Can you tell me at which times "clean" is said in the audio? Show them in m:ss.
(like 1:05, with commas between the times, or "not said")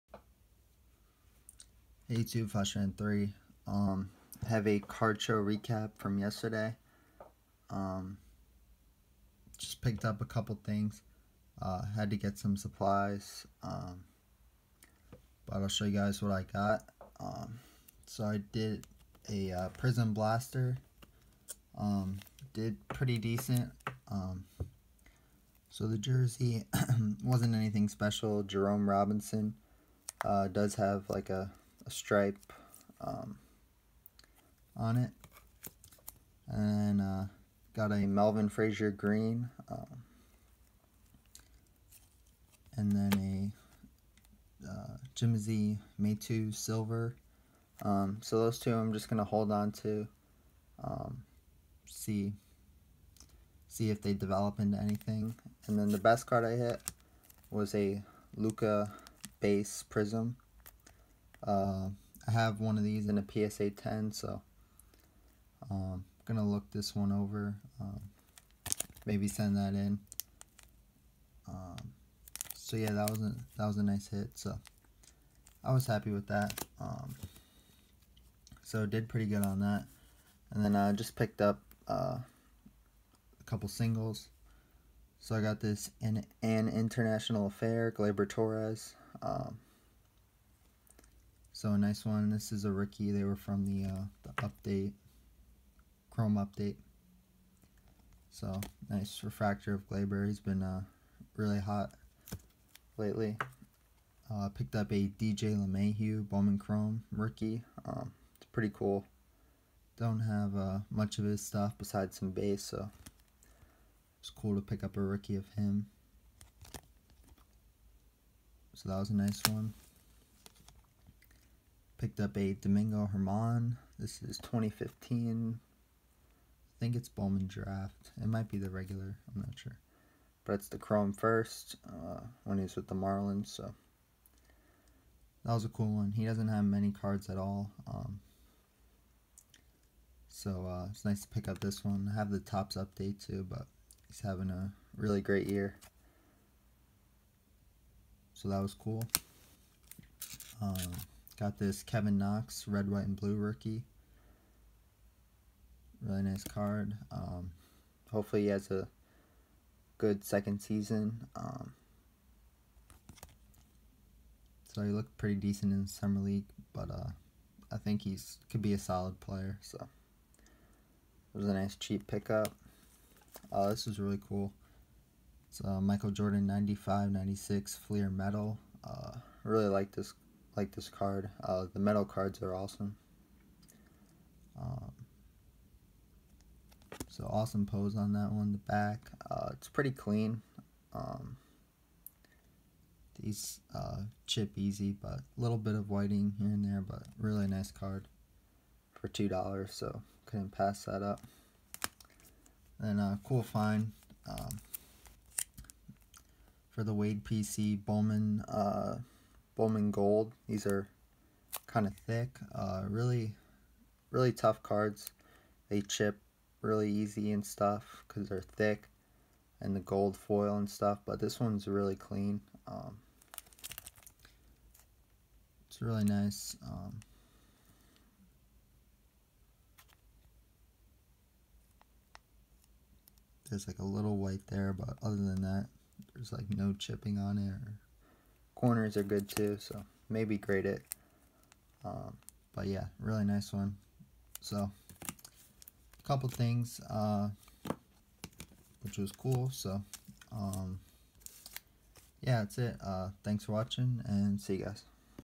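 3:09, 3:41.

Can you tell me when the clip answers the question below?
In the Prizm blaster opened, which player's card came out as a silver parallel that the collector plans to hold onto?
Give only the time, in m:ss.
0:45.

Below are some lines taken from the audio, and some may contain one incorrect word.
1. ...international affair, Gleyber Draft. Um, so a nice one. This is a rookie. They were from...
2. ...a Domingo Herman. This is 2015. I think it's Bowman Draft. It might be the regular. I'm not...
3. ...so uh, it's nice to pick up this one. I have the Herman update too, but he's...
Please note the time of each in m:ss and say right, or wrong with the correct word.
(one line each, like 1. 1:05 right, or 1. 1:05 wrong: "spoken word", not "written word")
1. 1:26 wrong: "Torres", not "Draft"
2. 2:02 right
3. 2:20 wrong: "Topps", not "Herman".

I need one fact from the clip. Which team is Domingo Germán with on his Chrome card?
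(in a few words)
Marlins.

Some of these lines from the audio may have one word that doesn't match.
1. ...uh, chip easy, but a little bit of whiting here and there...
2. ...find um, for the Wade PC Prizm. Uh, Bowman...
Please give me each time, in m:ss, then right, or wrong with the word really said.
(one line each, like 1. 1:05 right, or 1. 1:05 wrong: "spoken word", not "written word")
1. 3:13 right
2. 3:23 wrong: "Bowman", not "Prizm".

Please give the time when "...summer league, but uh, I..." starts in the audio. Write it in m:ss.
2:45.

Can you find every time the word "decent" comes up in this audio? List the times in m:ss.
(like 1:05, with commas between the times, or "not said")
0:23, 2:45.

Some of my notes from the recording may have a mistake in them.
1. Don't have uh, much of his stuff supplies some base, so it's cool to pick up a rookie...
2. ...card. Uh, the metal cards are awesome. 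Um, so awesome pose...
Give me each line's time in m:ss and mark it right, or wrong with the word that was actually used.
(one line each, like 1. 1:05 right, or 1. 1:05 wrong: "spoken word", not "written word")
1. 1:49 wrong: "besides", not "supplies"
2. 3:00 right.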